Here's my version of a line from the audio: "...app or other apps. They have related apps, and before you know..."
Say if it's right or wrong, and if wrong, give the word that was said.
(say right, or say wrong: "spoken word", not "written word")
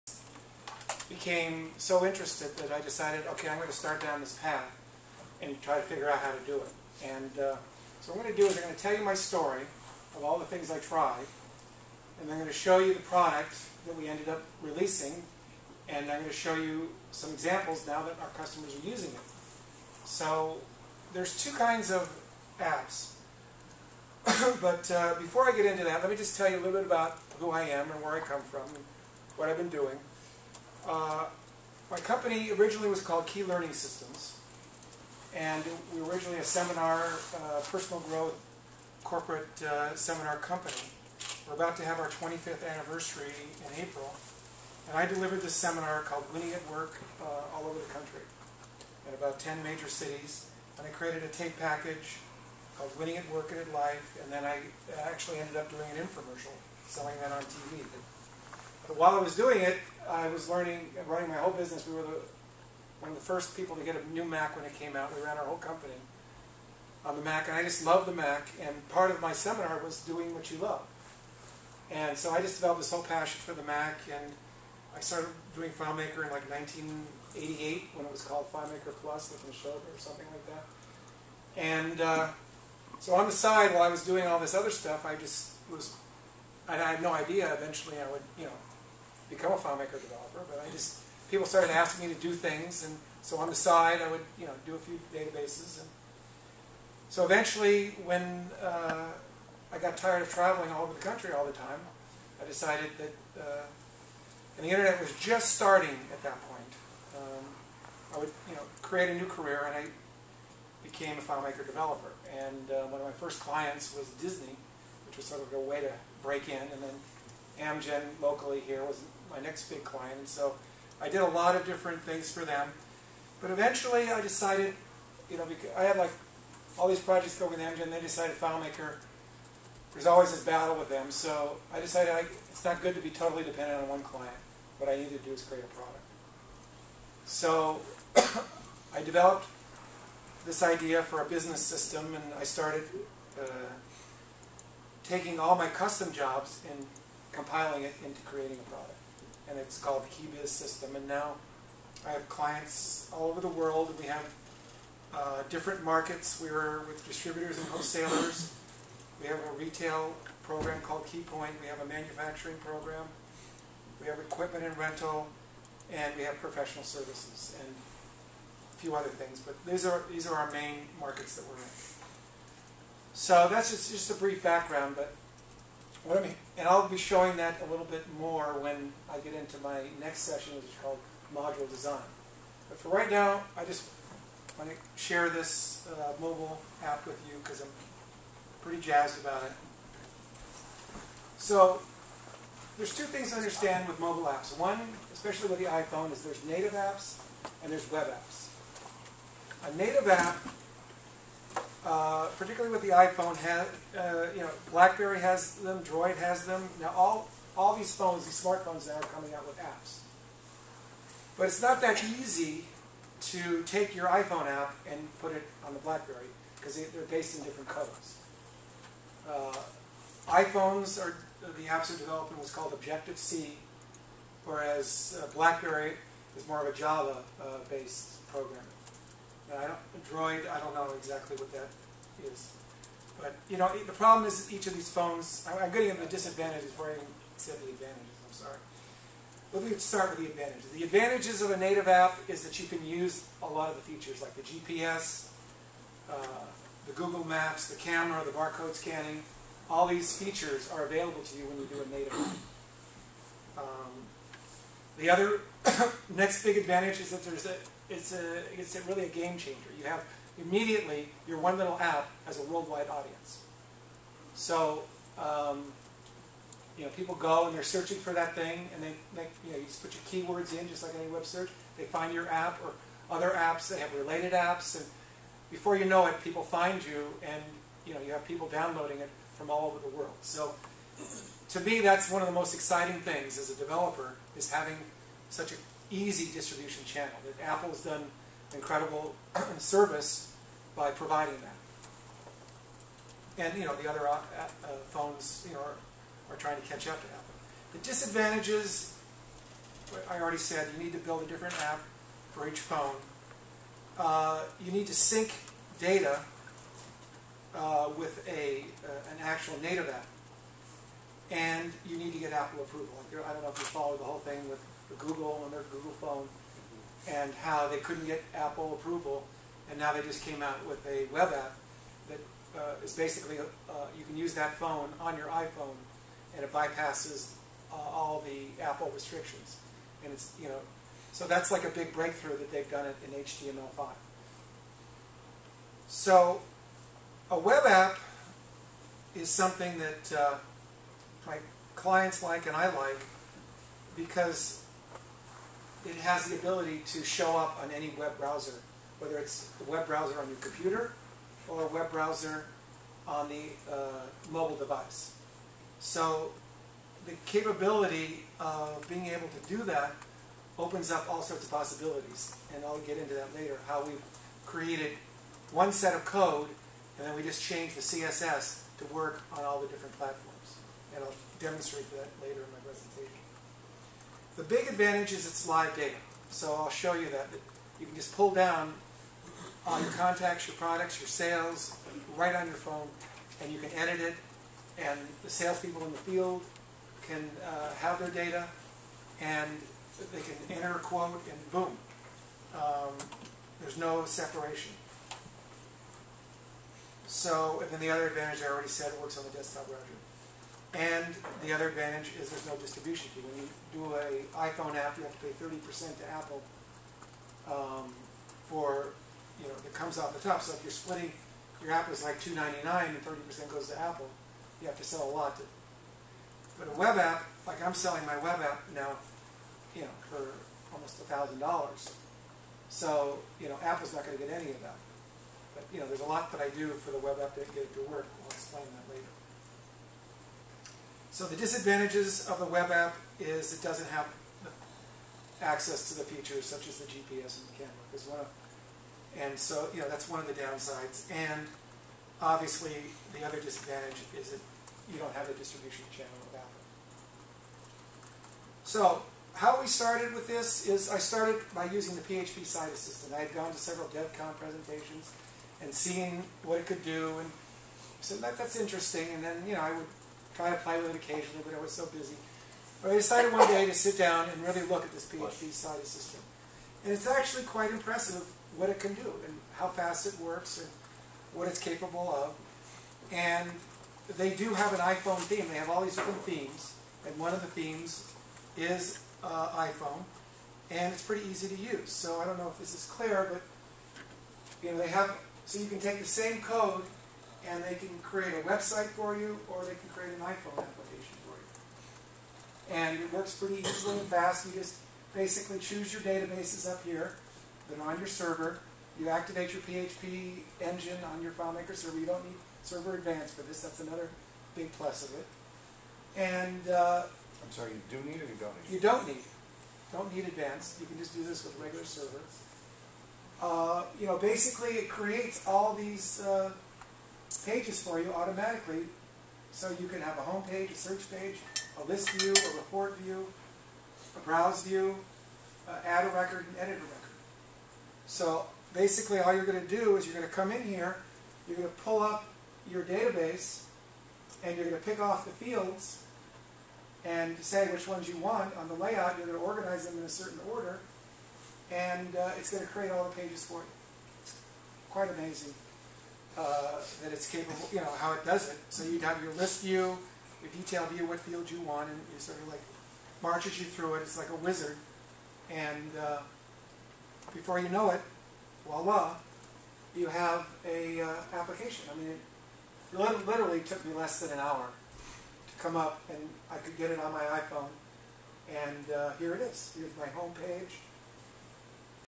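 right.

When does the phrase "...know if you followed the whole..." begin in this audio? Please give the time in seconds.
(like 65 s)
313 s.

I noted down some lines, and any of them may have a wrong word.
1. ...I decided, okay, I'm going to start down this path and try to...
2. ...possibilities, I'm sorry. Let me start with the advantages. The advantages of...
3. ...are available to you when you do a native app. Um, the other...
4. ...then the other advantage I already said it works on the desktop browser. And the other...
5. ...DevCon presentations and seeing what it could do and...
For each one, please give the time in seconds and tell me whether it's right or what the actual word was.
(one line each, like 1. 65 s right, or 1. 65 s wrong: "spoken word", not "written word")
1. 2 s right
2. 237 s wrong: "advantages", not "possibilities"
3. 250 s right
4. 397 s right
5. 453 s right.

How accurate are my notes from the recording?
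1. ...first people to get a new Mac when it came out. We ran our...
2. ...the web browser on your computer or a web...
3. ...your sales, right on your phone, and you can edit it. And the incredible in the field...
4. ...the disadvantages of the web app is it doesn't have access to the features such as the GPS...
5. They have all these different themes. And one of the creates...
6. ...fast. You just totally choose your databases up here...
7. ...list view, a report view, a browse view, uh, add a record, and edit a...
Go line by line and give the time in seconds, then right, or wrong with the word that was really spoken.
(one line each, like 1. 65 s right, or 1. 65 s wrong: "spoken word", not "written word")
1. 63 s right
2. 349 s right
3. 380 s wrong: "salespeople", not "incredible"
4. 431 s right
5. 475 s wrong: "themes", not "creates"
6. 494 s wrong: "basically", not "totally"
7. 521 s right.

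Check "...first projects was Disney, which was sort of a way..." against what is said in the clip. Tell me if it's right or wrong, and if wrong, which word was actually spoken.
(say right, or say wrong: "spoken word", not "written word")
wrong: "clients", not "projects".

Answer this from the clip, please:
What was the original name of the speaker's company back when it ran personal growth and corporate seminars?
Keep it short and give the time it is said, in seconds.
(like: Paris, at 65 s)
Ki Learning Systems, at 33 s.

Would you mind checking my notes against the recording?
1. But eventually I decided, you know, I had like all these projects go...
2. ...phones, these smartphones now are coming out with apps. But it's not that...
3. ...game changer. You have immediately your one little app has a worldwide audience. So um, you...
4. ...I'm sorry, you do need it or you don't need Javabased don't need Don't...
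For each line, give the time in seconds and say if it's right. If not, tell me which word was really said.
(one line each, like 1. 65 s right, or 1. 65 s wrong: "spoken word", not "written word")
1. 123 s right
2. 207 s right
3. 259 s right
4. 507 s wrong: "You", not "Javabased".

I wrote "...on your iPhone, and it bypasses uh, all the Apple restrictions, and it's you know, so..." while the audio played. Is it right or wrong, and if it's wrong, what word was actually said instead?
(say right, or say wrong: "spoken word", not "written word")
right.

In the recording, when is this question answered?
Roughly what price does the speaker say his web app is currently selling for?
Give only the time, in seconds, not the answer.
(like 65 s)
421 s.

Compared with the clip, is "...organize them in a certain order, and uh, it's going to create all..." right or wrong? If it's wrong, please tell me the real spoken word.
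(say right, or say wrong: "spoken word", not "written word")
right.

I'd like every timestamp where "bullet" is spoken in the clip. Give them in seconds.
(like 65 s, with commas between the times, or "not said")
not said.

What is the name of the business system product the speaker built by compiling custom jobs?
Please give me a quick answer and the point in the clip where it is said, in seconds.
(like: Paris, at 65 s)
KiBiz system, at 150 s.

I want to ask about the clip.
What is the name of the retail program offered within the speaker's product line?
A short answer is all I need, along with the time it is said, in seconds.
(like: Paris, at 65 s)
KeyPoint, at 161 s.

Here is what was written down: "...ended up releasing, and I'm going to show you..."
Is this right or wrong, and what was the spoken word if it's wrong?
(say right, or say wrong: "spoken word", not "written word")
right.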